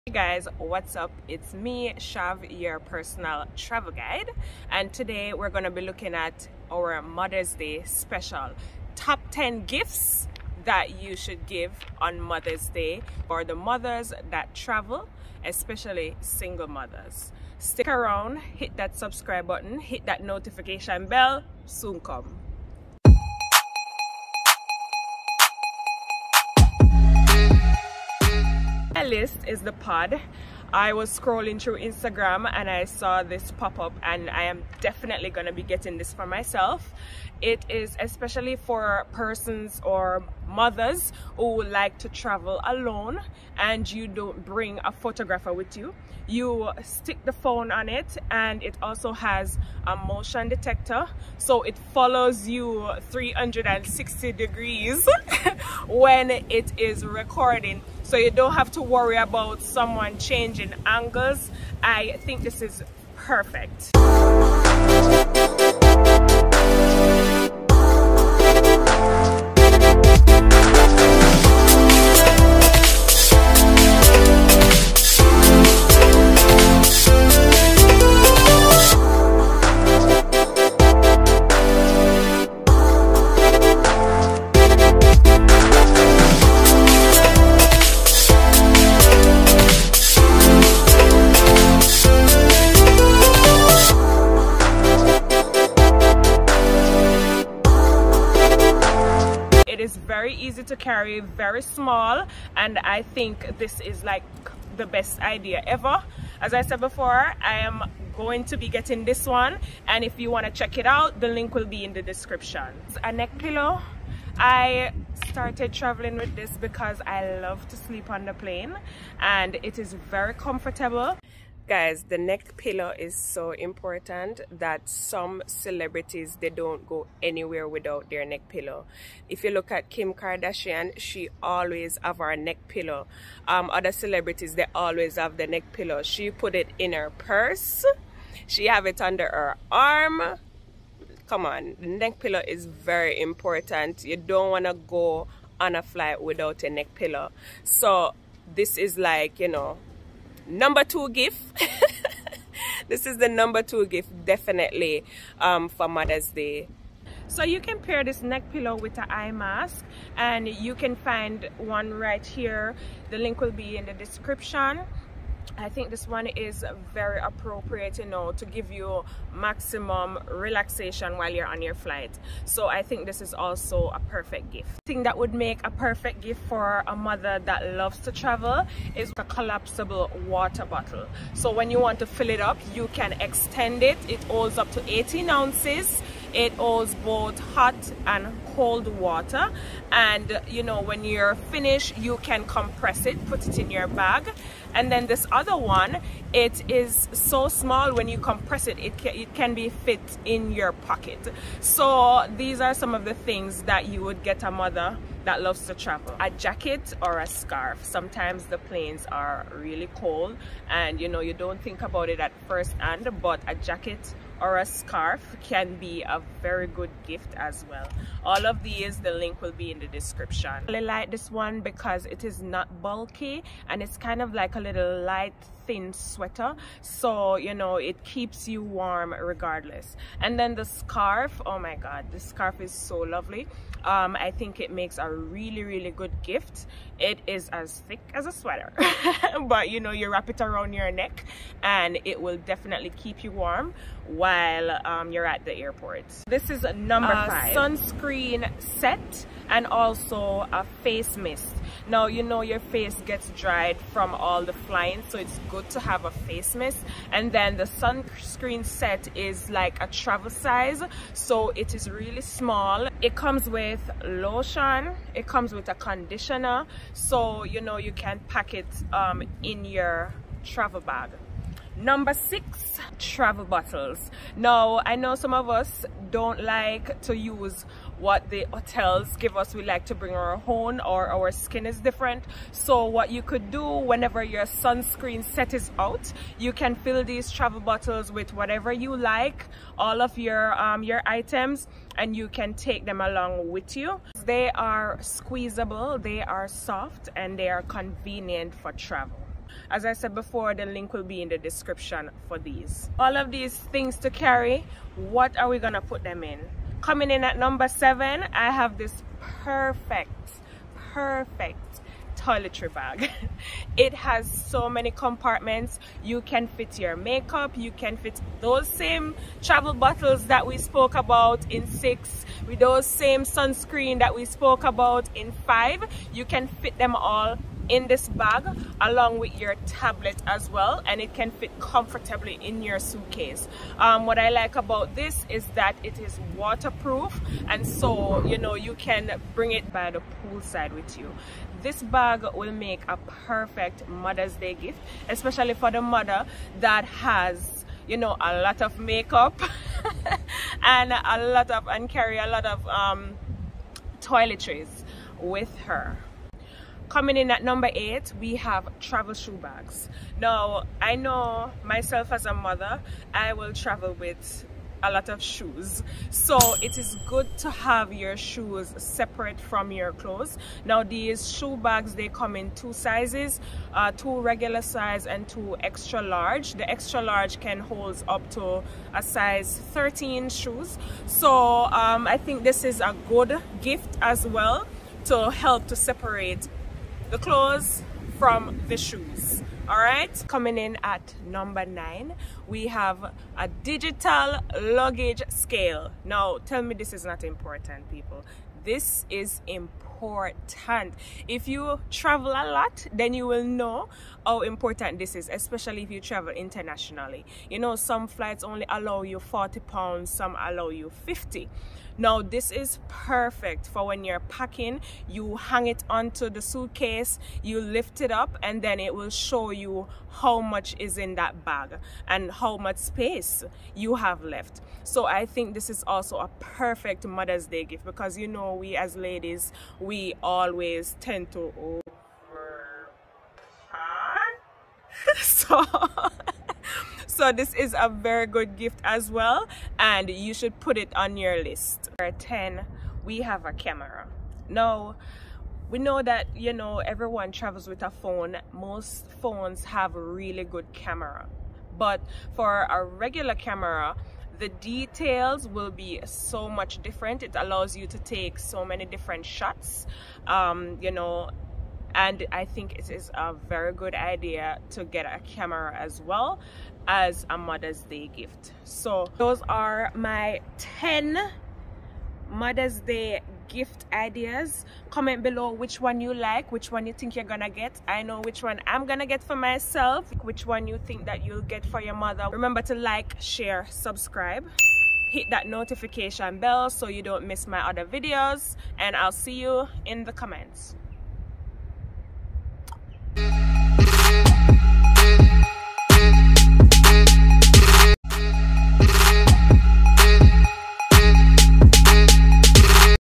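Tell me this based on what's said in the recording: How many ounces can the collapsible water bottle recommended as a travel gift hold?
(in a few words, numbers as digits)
18.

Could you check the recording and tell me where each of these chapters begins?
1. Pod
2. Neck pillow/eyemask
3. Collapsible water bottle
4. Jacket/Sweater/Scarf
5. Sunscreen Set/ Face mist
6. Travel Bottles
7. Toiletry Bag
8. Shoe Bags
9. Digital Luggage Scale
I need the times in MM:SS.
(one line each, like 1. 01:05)
1. 00:28
2. 01:53
3. 03:00
4. 03:27
5. 04:07
6. 04:33
7. 05:07
8. 05:57
9. 06:31.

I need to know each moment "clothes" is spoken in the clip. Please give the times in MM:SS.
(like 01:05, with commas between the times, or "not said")
06:09, 06:27.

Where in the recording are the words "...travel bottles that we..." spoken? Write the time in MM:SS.
05:19.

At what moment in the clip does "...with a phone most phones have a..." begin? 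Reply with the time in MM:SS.
07:27.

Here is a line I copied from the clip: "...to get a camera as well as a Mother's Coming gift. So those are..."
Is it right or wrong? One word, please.
wrong.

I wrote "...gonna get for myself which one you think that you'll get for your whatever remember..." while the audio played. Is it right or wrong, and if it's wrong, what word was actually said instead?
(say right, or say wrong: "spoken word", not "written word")
wrong: "mother", not "whatever".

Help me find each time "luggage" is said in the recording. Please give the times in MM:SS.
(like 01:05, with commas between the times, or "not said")
06:34.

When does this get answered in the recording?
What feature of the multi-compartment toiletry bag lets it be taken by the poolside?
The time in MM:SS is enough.
05:36.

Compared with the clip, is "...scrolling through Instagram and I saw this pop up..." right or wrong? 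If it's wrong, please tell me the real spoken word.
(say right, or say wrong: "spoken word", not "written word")
right.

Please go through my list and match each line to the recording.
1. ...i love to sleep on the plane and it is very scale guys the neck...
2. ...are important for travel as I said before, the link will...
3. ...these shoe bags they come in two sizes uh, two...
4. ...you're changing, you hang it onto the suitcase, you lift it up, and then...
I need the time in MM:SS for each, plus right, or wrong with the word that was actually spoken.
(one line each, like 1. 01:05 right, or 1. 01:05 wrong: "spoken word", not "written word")
1. 01:57 wrong: "comfortable", not "scale"
2. 04:57 wrong: "convenient", not "important"
3. 06:10 right
4. 06:54 wrong: "packing", not "changing".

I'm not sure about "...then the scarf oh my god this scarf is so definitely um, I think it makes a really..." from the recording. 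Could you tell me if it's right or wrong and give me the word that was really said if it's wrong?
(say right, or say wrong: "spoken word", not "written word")
wrong: "lovely", not "definitely".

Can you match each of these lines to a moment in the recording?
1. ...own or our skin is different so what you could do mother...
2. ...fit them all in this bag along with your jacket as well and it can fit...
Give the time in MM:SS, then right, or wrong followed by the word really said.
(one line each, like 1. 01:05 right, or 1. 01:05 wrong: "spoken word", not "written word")
1. 04:40 wrong: "whenever", not "mother"
2. 05:26 wrong: "tablet", not "jacket".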